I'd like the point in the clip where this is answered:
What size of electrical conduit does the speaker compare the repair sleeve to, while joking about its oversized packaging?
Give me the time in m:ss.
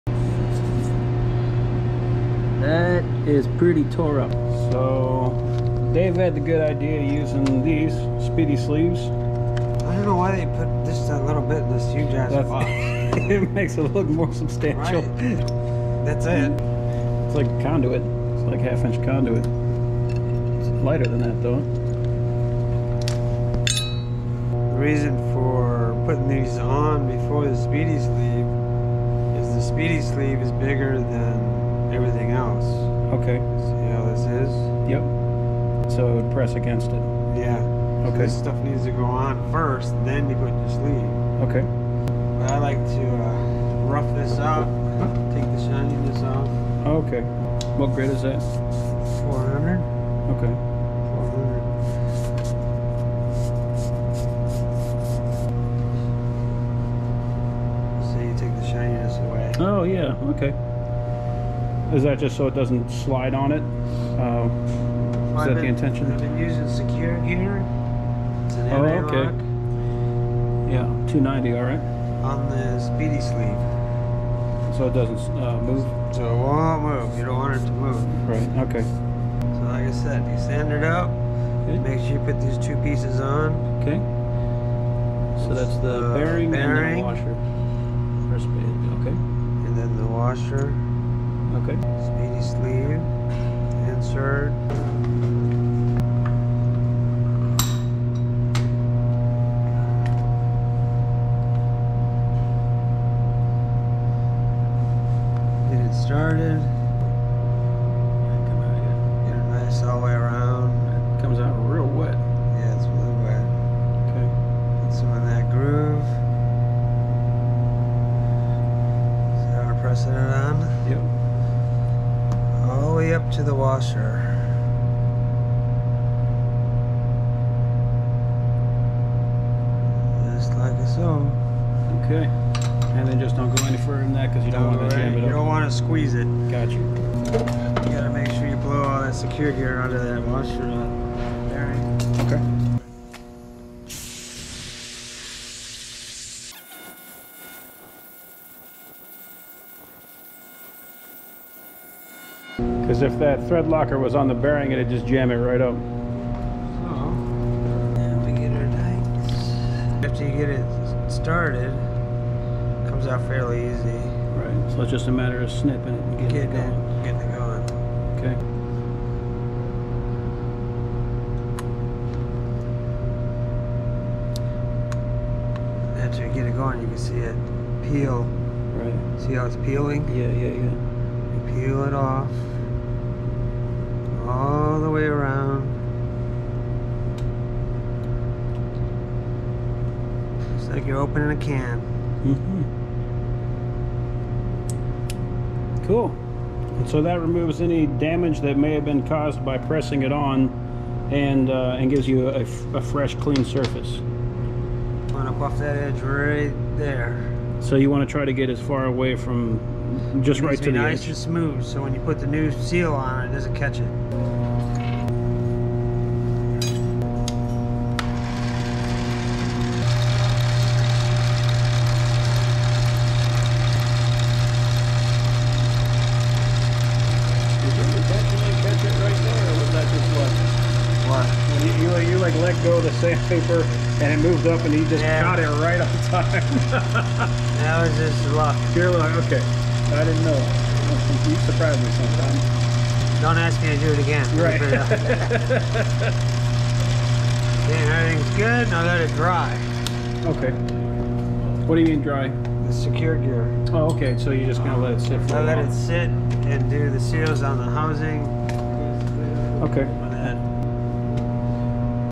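0:18.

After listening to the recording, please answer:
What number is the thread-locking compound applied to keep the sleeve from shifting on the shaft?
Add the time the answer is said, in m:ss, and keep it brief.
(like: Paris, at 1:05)
290, at 1:11.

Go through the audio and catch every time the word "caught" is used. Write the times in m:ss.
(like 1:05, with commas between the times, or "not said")
3:55.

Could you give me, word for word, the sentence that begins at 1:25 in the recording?
So that's the bearing, bearing, and the washer.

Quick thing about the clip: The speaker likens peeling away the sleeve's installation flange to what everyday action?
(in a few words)
opening a can.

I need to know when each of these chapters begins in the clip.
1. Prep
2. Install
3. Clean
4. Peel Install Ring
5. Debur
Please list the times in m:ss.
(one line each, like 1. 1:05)
1. 0:42
2. 1:19
3. 2:16
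4. 2:38
5. 3:25.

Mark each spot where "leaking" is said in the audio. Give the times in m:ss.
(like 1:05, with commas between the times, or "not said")
not said.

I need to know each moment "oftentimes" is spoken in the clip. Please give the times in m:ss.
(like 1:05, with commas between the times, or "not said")
not said.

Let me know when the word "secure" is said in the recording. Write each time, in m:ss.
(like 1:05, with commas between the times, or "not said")
1:06, 2:19, 4:12.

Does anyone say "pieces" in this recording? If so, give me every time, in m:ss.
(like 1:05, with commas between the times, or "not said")
1:22.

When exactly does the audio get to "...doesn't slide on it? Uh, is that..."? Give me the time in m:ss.
1:02.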